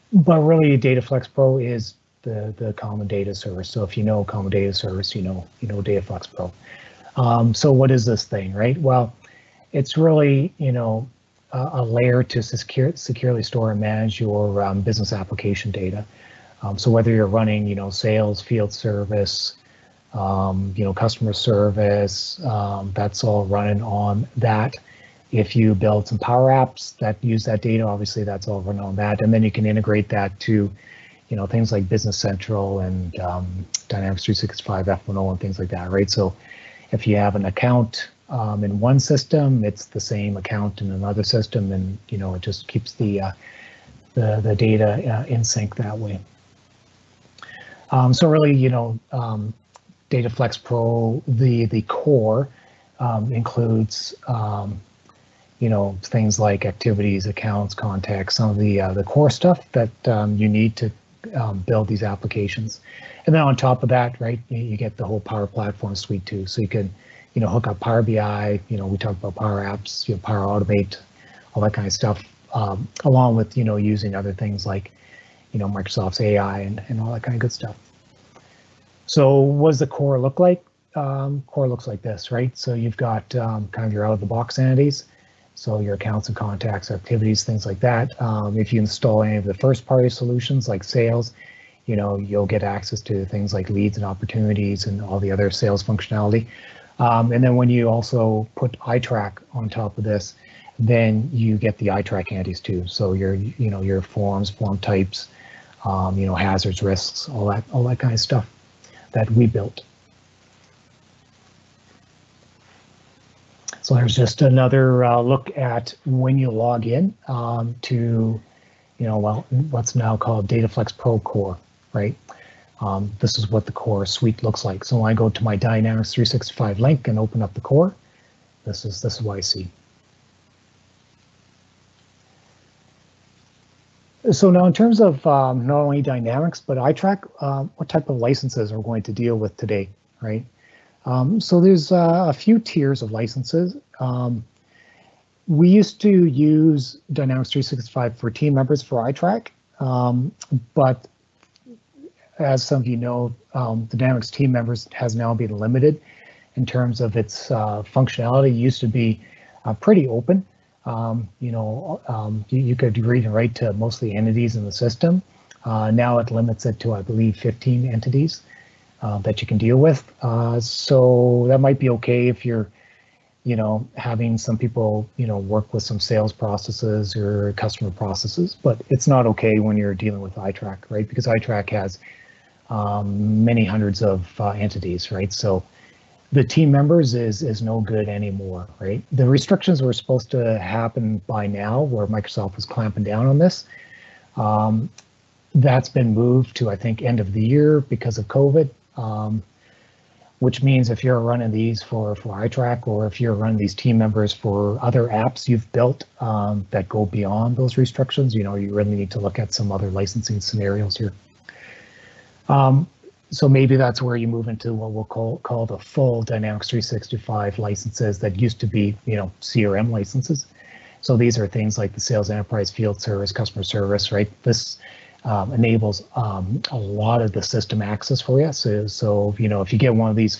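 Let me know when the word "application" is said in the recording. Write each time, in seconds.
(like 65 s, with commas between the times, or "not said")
15 s, 62 s.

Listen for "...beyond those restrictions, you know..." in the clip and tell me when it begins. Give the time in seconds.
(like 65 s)
207 s.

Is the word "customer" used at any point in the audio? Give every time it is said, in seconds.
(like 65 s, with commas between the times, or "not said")
20 s, 177 s, 223 s.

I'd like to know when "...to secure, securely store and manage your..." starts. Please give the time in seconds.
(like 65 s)
12 s.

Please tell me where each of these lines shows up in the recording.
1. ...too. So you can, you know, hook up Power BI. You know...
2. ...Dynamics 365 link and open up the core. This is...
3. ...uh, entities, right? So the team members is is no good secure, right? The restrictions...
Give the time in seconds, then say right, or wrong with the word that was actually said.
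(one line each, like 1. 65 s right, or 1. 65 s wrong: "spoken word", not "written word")
1. 66 s right
2. 125 s right
3. 184 s wrong: "anymore", not "secure".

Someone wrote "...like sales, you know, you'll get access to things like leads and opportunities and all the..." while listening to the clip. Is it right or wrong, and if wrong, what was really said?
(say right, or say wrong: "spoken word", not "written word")
right.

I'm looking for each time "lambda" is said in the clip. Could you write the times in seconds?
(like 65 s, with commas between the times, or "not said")
not said.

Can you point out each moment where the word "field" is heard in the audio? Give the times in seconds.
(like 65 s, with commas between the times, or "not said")
18 s, 222 s.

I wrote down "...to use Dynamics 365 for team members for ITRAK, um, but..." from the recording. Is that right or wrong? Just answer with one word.
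right.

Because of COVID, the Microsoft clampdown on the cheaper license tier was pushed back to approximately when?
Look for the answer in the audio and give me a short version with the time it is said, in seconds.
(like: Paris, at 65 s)
End of the year, at 197 s.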